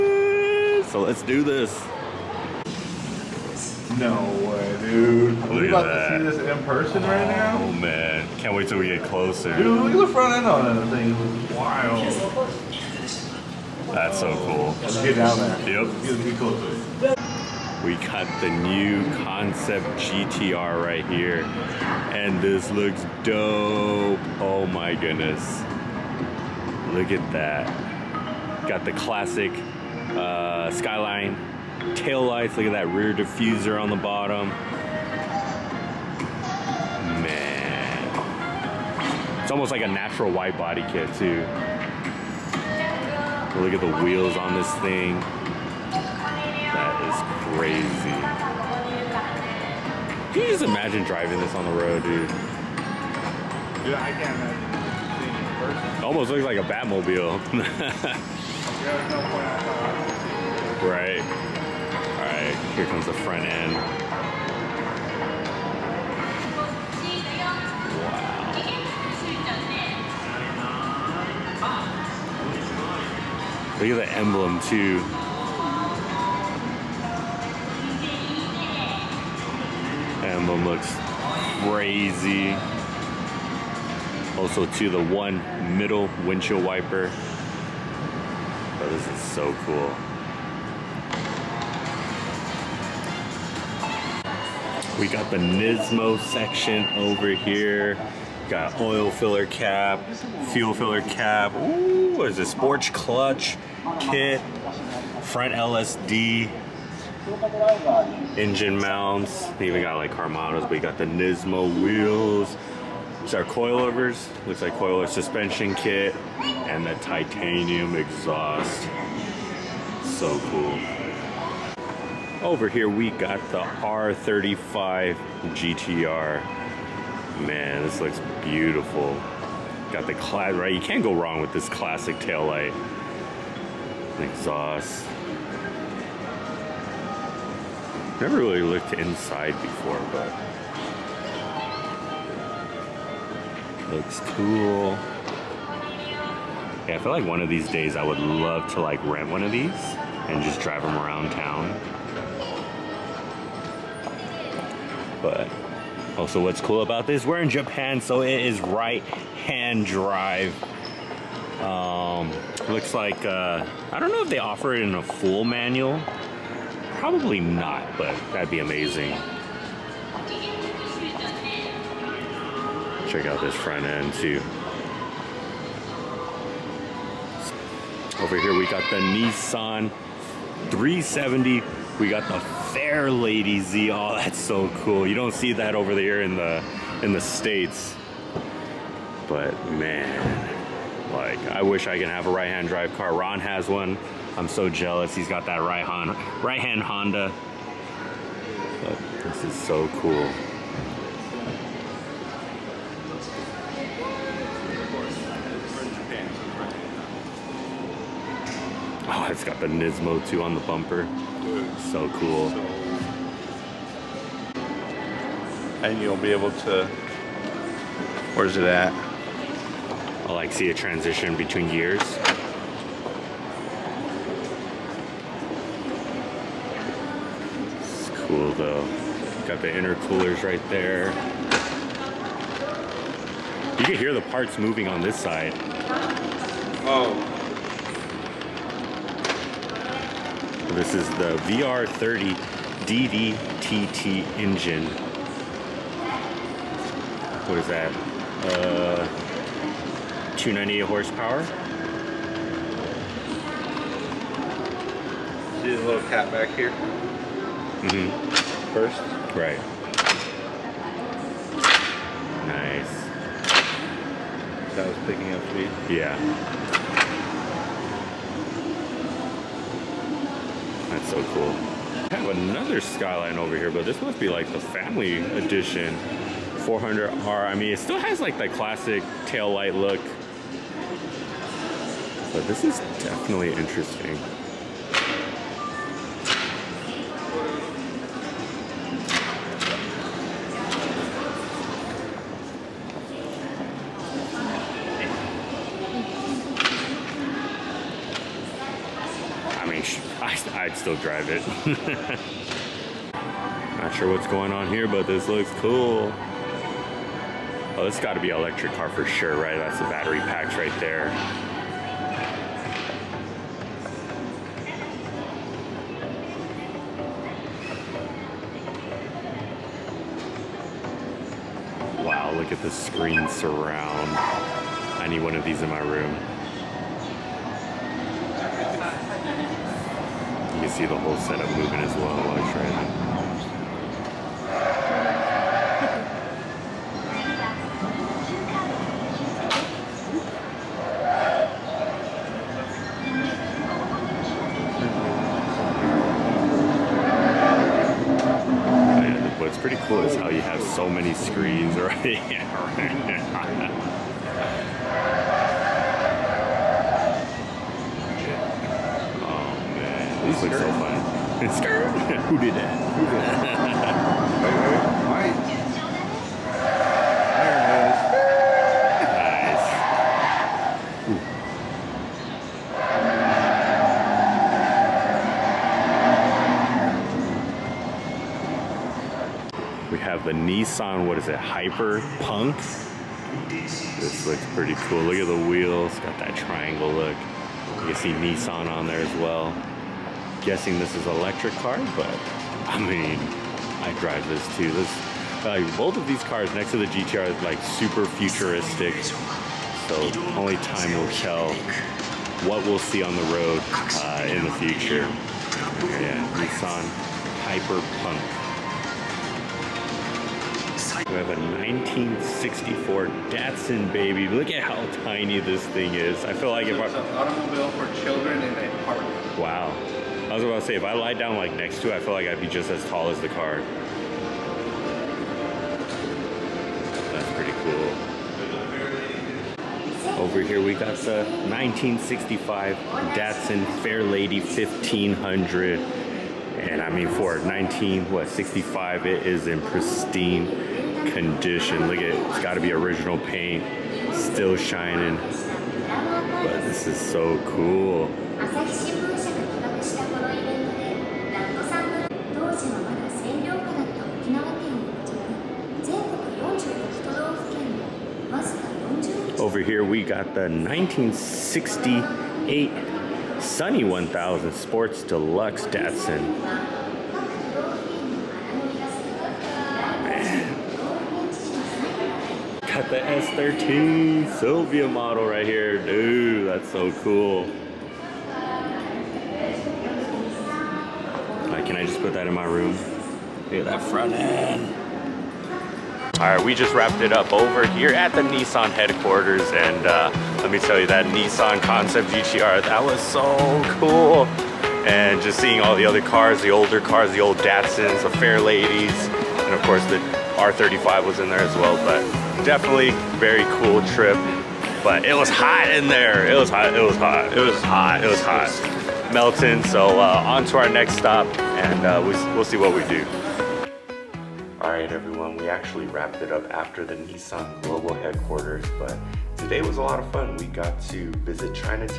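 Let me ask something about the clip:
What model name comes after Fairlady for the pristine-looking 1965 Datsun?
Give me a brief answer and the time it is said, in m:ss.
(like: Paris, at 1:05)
1500, at 7:13.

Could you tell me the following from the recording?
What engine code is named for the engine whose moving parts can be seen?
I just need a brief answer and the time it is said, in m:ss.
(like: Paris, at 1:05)
VR30 DDTT, at 4:01.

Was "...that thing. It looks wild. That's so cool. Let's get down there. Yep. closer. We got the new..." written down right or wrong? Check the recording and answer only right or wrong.
right.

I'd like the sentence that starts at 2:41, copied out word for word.
Um, looks like, uh, I don't know if they offer it in a full manual.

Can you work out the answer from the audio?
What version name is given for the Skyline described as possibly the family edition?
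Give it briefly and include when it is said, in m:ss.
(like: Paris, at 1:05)
400R, at 4:36.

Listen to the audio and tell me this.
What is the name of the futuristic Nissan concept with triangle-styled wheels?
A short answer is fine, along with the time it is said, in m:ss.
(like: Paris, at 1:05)
Hyper Punk, at 6:21.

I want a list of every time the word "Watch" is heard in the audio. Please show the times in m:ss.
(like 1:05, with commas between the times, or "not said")
5:32.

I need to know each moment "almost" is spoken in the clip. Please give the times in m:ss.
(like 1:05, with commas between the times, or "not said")
0:39, 0:56.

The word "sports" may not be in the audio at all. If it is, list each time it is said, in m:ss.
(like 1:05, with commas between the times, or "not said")
1:42, 7:44.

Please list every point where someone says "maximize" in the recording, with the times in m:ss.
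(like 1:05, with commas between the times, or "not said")
not said.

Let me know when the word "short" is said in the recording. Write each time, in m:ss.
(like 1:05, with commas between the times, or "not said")
not said.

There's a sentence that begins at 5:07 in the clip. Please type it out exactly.
Oh, it's gotta be electric car for sure, right?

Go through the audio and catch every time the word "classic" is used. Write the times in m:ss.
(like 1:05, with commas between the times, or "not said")
0:28, 2:11, 4:38.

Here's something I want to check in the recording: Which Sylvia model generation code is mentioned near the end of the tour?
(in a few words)
S13.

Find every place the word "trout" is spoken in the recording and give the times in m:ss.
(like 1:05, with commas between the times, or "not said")
not said.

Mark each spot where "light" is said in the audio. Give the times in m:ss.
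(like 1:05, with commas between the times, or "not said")
0:32, 2:12, 4:39.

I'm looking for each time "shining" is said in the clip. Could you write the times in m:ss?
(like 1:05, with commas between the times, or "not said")
7:24.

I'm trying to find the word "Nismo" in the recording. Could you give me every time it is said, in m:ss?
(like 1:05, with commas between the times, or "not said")
1:35, 1:51, 3:29.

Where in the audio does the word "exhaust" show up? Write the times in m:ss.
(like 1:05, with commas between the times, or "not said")
1:57, 2:14.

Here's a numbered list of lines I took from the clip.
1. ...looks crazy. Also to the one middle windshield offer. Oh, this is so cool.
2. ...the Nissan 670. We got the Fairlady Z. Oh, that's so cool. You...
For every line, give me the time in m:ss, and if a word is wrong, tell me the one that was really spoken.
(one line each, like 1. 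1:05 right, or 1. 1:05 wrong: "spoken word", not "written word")
1. 1:20 wrong: "wiper", not "offer"
2. 2:58 wrong: "370", not "670".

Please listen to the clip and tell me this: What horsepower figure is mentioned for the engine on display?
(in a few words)
298.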